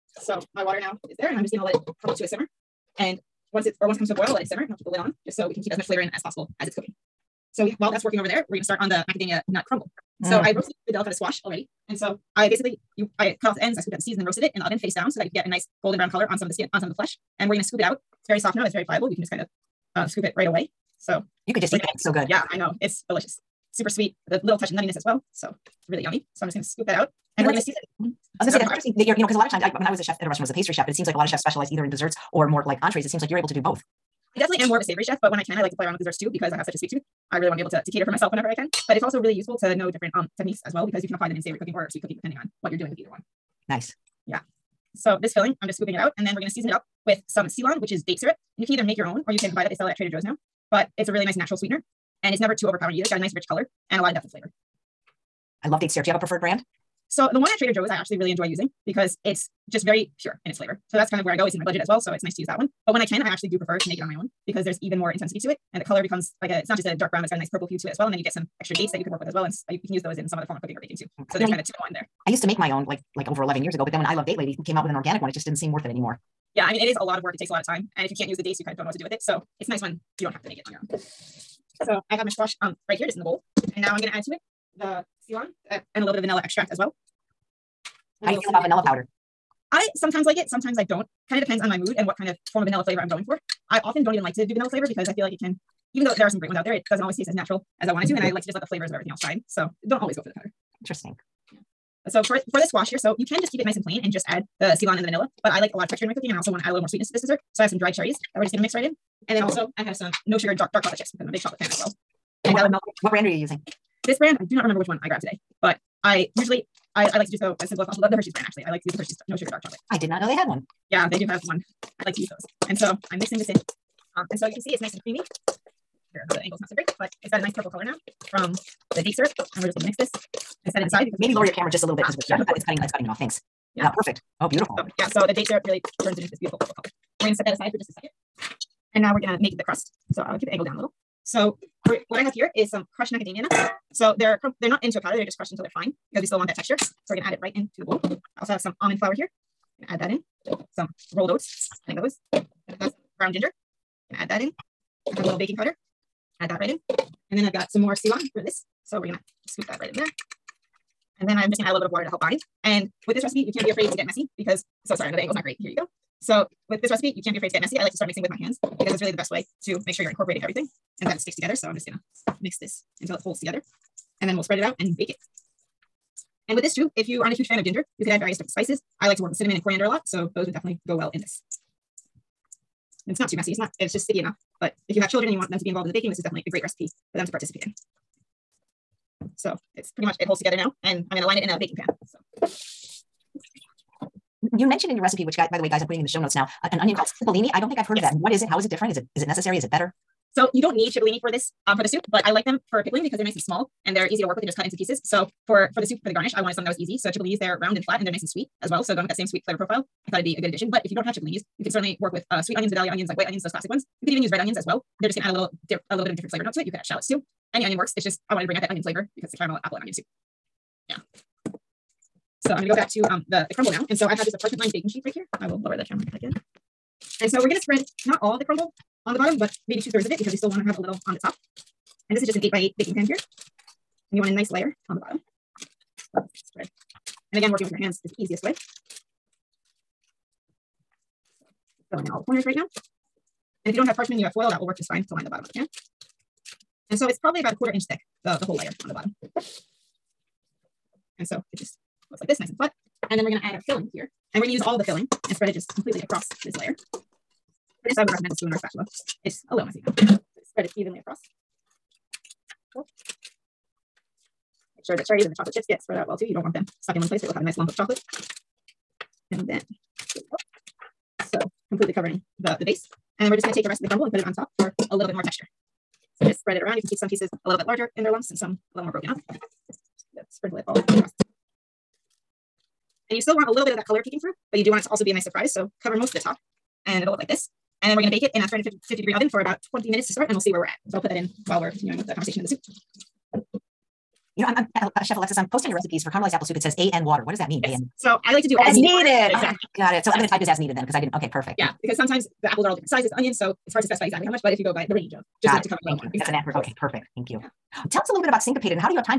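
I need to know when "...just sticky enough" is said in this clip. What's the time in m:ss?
3:03.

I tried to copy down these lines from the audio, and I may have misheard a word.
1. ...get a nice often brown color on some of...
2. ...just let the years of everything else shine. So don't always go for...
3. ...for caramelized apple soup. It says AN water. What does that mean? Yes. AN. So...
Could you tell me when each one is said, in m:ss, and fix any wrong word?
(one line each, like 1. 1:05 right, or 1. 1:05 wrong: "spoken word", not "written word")
1. 0:15 wrong: "golden", not "often"
2. 1:38 wrong: "flavors", not "years"
3. 4:56 right.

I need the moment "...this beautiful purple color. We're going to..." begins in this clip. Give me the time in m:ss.
2:16.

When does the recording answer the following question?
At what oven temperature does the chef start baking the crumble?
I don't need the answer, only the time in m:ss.
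4:48.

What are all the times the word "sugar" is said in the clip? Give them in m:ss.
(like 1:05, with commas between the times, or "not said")
1:50, 1:59.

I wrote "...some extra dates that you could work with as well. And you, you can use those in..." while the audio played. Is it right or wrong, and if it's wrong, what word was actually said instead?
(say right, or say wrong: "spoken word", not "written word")
right.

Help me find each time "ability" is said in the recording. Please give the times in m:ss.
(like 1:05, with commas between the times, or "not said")
not said.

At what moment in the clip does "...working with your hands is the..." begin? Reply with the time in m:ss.
3:57.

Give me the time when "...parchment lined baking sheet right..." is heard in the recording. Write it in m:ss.
3:44.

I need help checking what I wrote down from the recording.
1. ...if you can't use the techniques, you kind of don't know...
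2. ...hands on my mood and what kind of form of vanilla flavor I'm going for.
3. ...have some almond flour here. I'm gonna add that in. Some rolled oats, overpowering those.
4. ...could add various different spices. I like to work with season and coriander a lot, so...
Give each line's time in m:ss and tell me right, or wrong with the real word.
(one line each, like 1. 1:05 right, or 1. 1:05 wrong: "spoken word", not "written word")
1. 1:18 wrong: "dates", not "techniques"
2. 1:31 wrong: "depends", not "hands"
3. 2:28 wrong: "adding", not "overpowering"
4. 2:58 wrong: "cinnamon", not "season".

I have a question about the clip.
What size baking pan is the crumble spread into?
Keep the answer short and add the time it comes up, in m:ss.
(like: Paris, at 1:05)
8 by 8, at 3:52.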